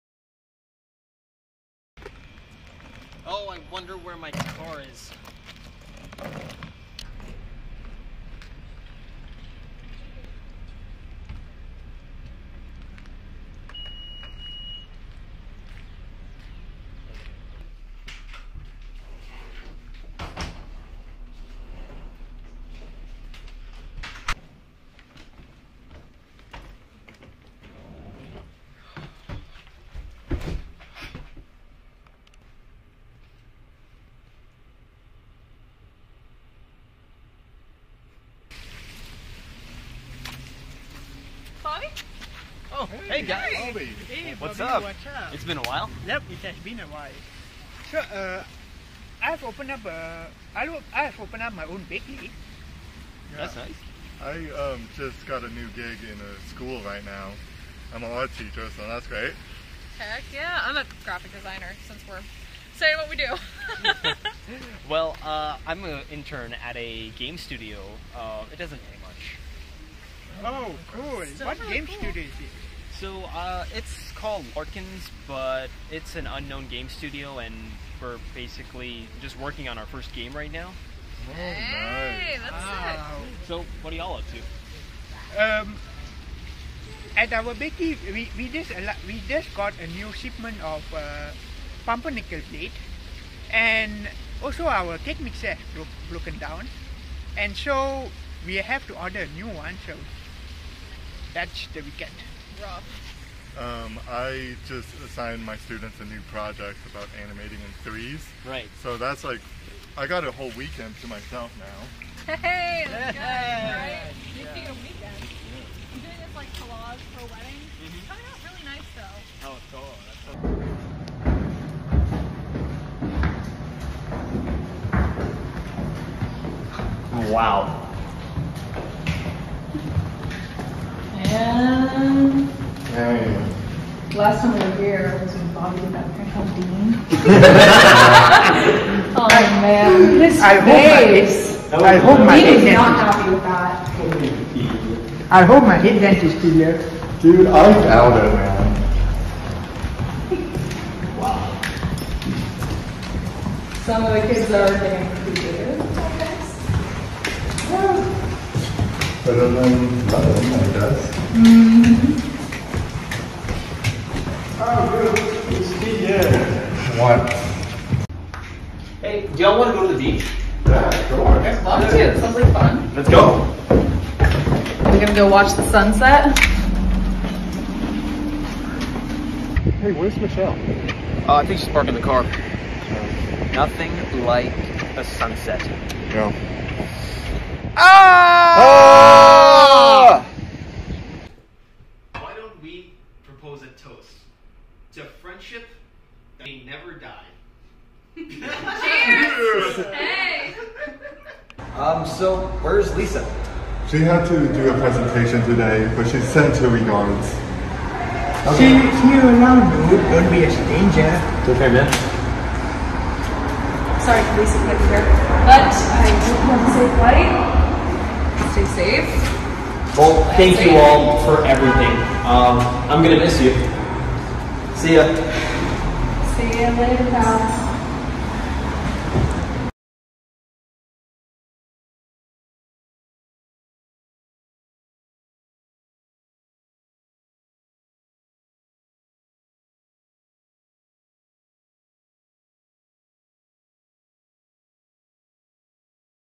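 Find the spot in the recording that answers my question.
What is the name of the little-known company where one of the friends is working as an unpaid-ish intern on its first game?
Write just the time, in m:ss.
1:14.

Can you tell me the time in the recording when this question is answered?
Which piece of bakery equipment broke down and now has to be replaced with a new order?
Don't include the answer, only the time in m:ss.
1:34.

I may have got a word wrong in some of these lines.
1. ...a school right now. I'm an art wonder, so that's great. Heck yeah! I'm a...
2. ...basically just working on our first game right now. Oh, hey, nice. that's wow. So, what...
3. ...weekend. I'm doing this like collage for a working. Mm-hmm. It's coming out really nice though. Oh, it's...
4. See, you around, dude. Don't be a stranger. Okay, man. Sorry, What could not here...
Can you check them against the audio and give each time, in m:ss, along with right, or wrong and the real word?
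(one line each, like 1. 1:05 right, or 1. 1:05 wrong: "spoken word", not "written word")
1. 0:56 wrong: "teacher", not "wonder"
2. 1:18 right
3. 1:54 wrong: "wedding", not "working"
4. 3:28 wrong: "Lisa", not "What".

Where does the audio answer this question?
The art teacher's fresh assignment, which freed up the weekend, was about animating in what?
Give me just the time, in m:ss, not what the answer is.
1:47.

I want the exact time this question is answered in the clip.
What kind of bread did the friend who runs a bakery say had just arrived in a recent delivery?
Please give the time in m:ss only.
1:31.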